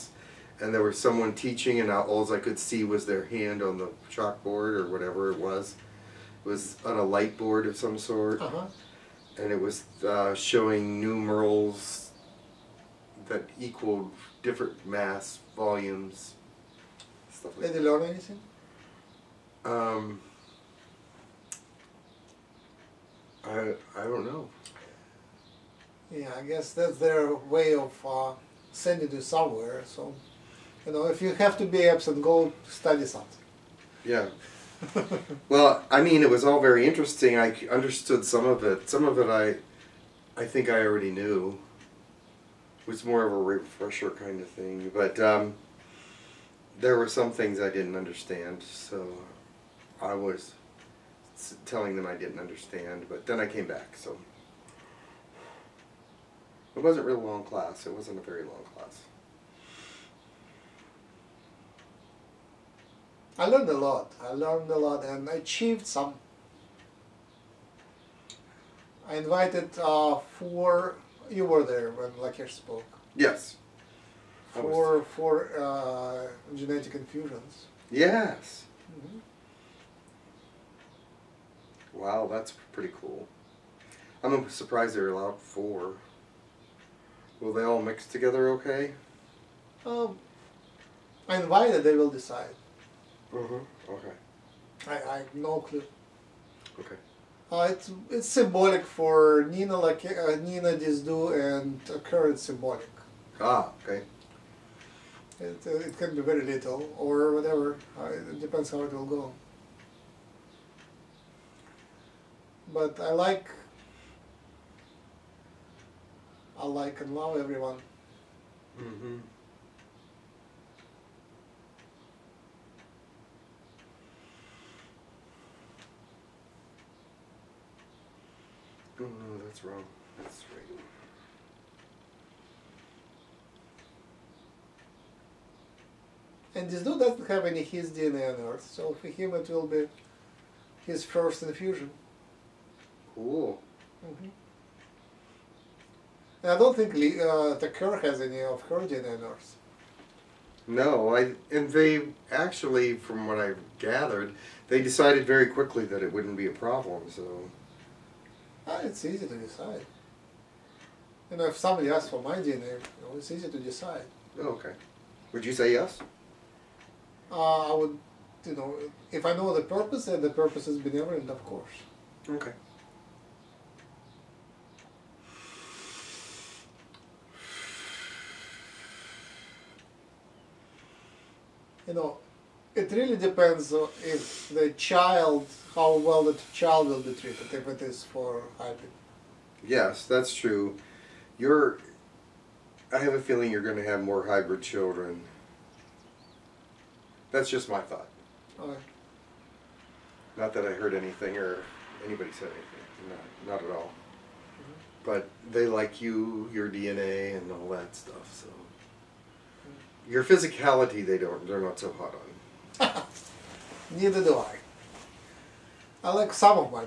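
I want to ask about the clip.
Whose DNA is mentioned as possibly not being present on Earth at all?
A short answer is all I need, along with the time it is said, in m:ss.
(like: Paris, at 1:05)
Lee, at 2:26.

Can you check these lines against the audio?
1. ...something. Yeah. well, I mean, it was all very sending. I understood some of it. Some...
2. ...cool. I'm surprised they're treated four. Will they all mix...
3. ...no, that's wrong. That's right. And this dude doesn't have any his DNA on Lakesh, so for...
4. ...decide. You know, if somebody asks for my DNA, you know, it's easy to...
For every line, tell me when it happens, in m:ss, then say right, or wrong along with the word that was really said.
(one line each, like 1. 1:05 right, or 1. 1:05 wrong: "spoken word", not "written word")
1. 0:33 wrong: "interesting", not "sending"
2. 1:23 wrong: "allowed", not "treated"
3. 2:09 wrong: "Earth", not "Lakesh"
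4. 2:39 right.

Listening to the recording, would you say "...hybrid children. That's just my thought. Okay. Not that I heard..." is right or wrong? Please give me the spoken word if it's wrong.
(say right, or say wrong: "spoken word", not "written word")
right.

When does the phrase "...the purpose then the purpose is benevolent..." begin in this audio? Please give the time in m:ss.
2:49.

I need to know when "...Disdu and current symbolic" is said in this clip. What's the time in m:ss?
1:40.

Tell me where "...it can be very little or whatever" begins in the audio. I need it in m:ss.
1:45.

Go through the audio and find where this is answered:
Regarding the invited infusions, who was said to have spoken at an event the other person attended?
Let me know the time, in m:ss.
1:12.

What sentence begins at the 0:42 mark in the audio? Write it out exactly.
It was more of a refresher kind of thing.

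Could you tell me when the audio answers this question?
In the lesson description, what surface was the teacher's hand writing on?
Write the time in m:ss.
0:07.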